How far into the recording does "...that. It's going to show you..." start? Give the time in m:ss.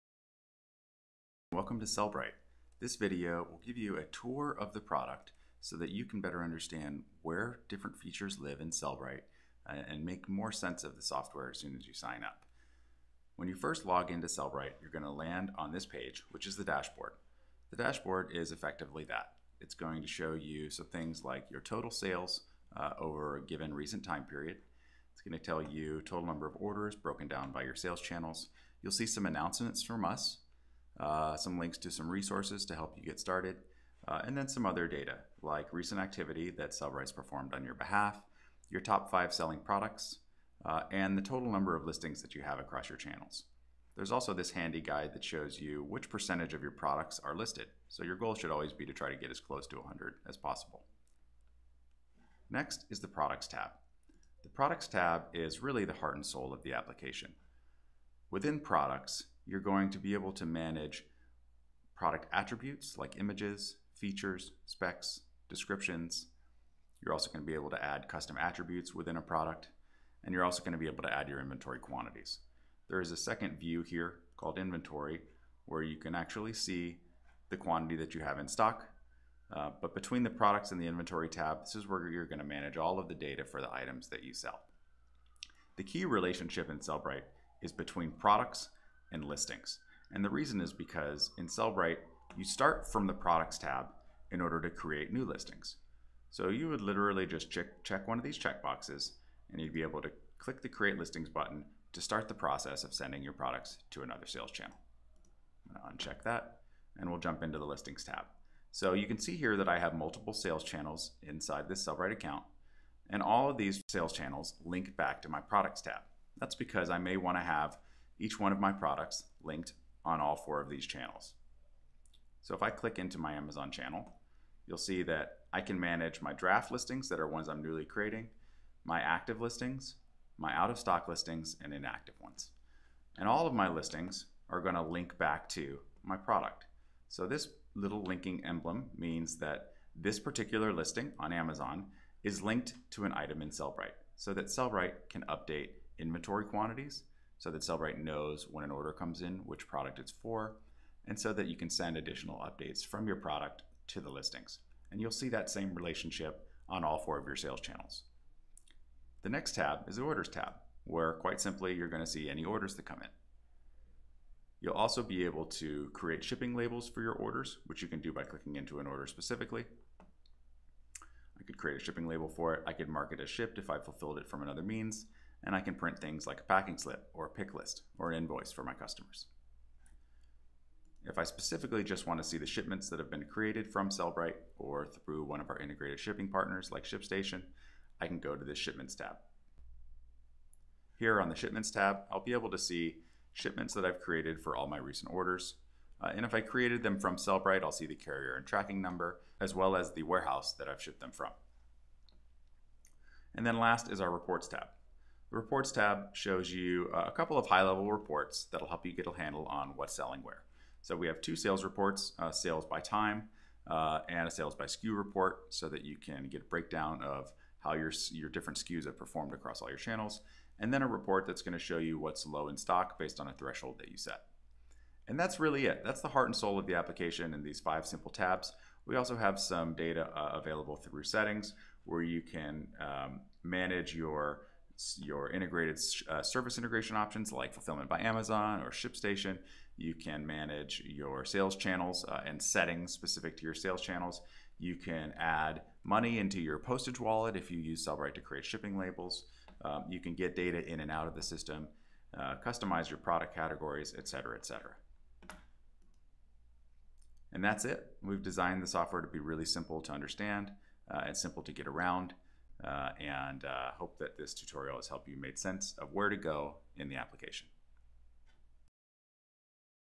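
0:19.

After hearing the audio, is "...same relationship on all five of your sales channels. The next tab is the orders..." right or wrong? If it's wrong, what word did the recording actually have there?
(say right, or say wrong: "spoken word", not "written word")
wrong: "four", not "five".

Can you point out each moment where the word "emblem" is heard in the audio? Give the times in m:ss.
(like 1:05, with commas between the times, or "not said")
2:18.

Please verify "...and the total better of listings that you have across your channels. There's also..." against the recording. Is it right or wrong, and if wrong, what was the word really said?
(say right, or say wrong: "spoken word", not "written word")
wrong: "number", not "better".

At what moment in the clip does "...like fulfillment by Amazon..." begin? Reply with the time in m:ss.
3:57.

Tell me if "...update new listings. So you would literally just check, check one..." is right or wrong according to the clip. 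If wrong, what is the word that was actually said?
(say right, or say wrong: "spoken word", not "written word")
wrong: "create", not "update".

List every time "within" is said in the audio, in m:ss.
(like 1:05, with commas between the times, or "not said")
0:58, 1:08.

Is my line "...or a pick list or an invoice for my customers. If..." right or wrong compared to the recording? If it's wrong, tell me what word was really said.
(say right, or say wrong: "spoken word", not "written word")
right.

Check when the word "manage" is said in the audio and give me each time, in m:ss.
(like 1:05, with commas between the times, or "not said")
1:00, 1:22, 2:05, 3:53, 4:00.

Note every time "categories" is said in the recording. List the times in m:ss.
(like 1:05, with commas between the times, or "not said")
4:13.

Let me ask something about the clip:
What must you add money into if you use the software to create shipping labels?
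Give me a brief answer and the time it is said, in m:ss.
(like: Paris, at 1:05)
postage wallet, at 4:06.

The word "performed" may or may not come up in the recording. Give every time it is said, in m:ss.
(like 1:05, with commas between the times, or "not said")
0:37, 3:38.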